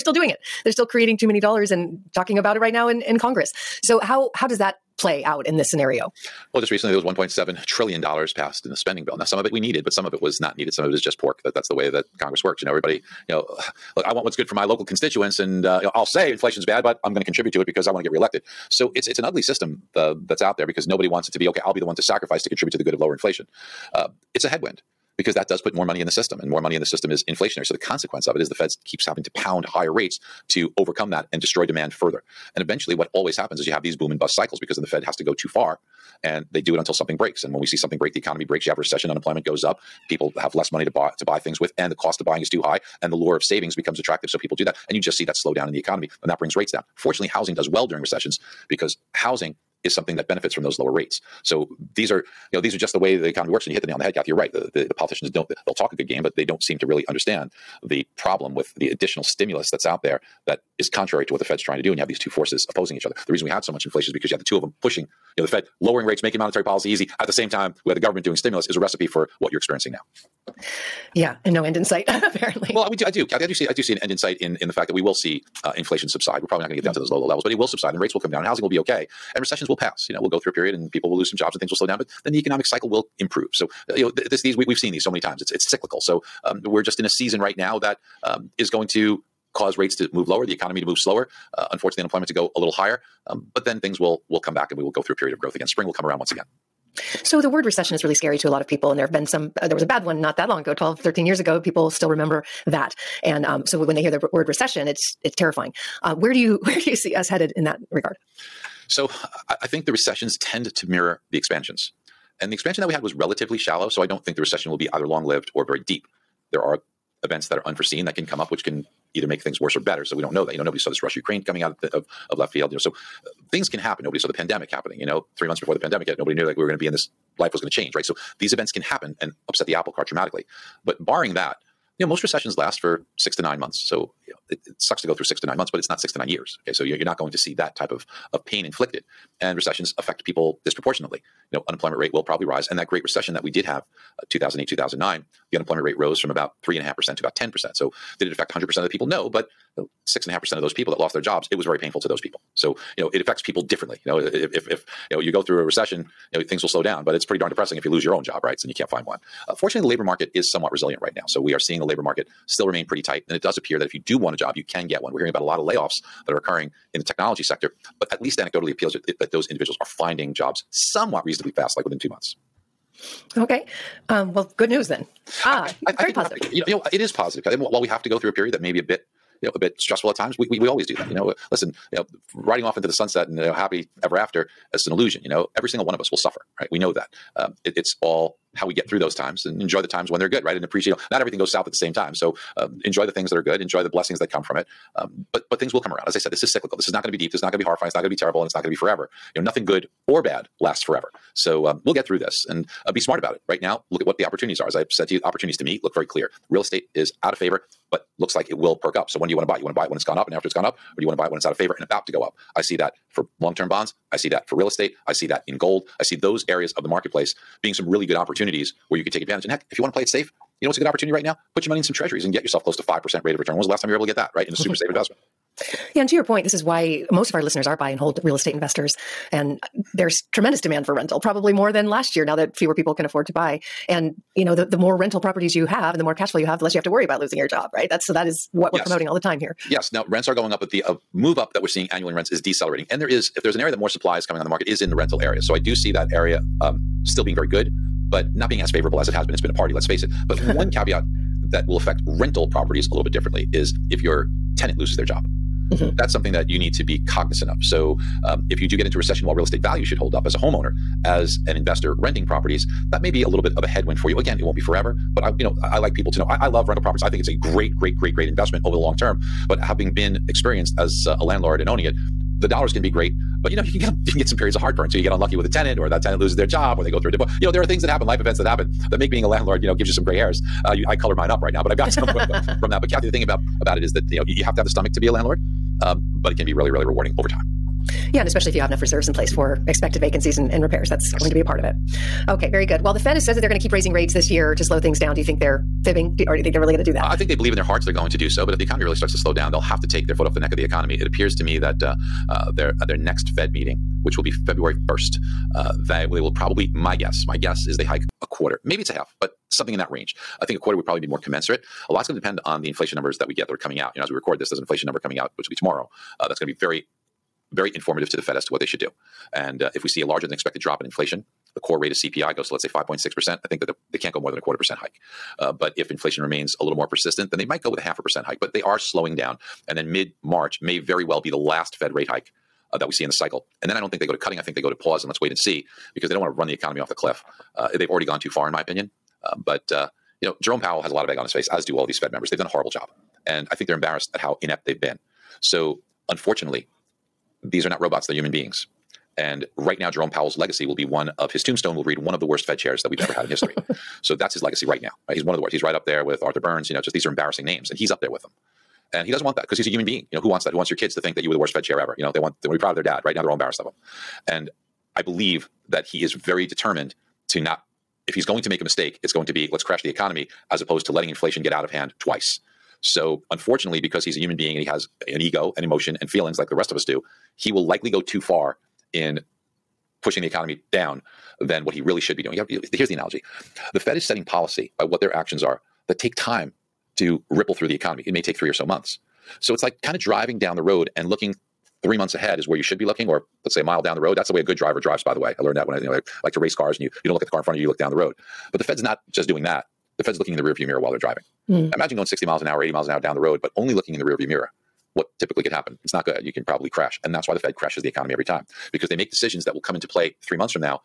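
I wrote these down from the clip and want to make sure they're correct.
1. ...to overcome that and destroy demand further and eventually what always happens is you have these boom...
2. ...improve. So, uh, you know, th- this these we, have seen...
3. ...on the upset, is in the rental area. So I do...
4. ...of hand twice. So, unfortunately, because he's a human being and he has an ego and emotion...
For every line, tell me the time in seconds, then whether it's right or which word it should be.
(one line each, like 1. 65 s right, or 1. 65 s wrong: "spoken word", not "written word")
1. 30 s right
2. 83 s right
3. 244 s wrong: "market", not "upset"
4. 371 s right.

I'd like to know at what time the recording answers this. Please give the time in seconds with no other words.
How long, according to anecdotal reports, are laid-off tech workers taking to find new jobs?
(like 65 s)
171 s.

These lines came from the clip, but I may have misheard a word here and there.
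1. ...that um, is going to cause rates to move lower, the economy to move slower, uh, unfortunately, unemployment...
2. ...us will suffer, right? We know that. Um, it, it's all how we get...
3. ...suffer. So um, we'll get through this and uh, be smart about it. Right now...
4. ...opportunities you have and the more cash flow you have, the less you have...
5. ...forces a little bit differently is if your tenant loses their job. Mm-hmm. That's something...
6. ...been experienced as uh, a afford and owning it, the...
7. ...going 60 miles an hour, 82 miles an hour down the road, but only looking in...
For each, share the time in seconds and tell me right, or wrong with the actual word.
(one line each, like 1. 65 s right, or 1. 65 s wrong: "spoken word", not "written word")
1. 87 s right
2. 185 s right
3. 200 s wrong: "forever", not "suffer"
4. 235 s wrong: "properties", not "opportunities"
5. 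252 s wrong: "properties", not "forces"
6. 269 s wrong: "landlord", not "afford"
7. 401 s wrong: "80", not "82".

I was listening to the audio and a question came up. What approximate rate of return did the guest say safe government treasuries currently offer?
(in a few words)
5%.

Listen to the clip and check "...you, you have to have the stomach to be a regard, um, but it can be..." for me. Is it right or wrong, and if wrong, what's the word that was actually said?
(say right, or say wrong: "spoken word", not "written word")
wrong: "landlord", not "regard".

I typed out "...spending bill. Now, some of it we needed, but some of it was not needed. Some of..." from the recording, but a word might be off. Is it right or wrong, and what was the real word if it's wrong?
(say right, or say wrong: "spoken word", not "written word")
right.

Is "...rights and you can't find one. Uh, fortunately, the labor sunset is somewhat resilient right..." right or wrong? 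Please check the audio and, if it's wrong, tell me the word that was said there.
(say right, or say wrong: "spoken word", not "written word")
wrong: "market", not "sunset".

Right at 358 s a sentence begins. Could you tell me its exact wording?
And he doesn't want that because he's a human being.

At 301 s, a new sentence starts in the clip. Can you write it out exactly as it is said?
It appears to me that uh, uh, they're at their next Fed meeting, which will be February 1st.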